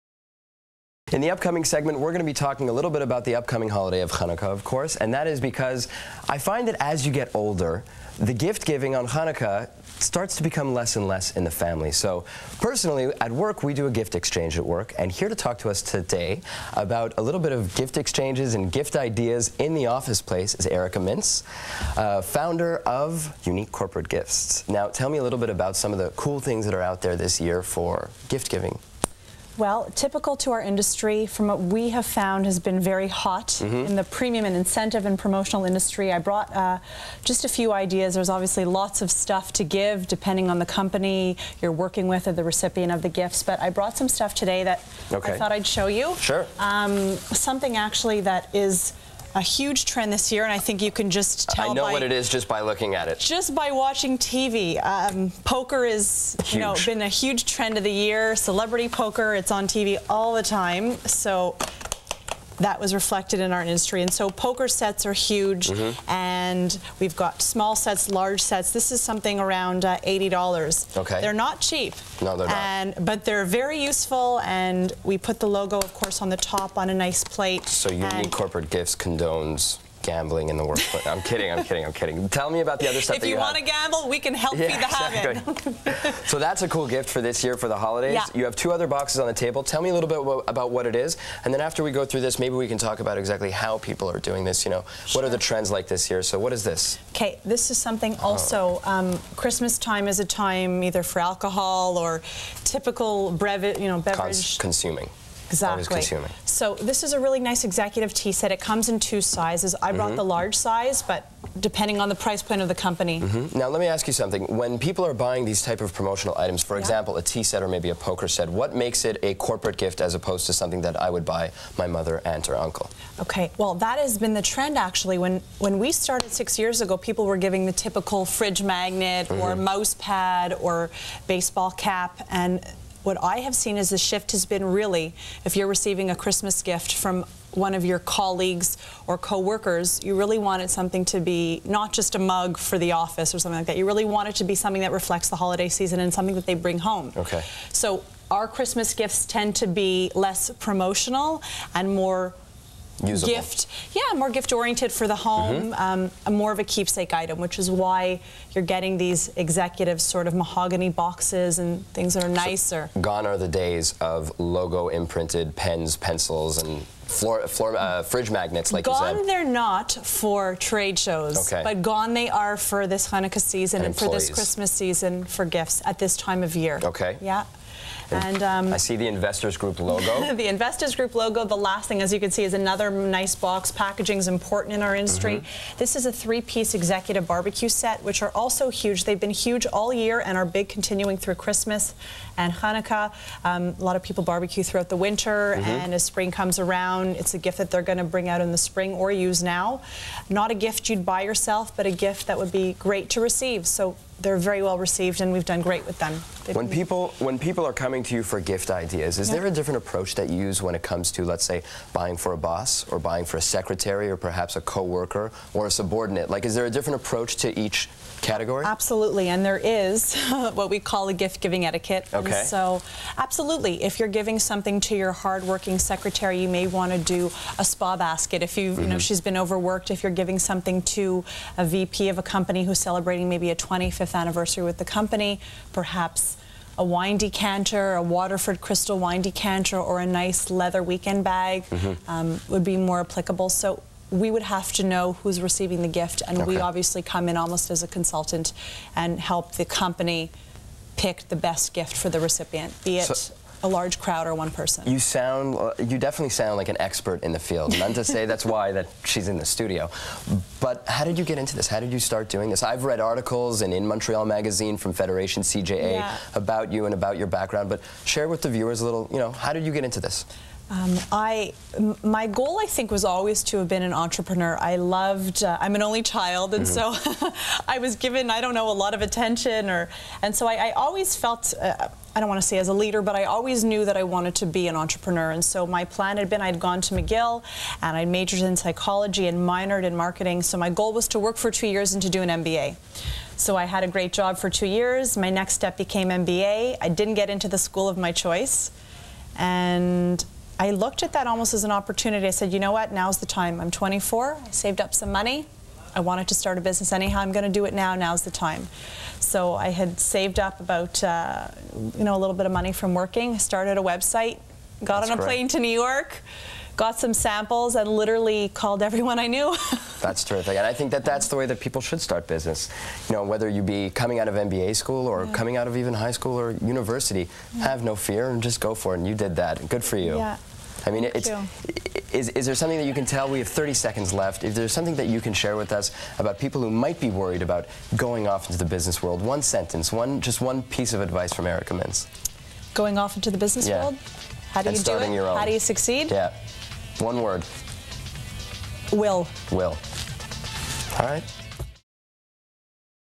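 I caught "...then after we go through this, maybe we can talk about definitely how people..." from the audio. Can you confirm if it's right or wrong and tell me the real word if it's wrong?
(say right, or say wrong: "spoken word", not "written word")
wrong: "exactly", not "definitely".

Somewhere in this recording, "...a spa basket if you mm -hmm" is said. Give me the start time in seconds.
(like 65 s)
227 s.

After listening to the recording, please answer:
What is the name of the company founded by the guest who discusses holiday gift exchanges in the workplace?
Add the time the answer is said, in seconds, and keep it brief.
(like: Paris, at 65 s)
Unique Corporate Gifts, at 23 s.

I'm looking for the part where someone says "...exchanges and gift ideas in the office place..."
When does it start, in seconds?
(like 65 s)
17 s.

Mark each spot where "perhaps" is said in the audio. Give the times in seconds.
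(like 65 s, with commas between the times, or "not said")
214 s, 235 s.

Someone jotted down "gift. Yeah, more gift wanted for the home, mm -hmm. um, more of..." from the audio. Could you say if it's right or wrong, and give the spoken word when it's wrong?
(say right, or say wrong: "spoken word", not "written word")
wrong: "oriented", not "wanted".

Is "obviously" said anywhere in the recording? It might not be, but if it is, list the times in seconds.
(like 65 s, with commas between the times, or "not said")
38 s, 246 s.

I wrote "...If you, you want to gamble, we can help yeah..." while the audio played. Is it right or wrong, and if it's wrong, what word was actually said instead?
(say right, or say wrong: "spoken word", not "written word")
right.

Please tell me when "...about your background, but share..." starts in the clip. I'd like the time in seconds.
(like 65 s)
266 s.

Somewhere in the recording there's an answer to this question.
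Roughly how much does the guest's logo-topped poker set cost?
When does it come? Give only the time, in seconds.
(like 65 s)
70 s.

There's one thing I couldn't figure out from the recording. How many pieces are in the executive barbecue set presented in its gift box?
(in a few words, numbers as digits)
3.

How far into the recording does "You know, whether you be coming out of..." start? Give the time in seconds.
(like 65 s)
323 s.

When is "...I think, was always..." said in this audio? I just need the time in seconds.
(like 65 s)
272 s.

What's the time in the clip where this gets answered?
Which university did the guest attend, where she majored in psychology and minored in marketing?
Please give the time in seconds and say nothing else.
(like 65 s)
286 s.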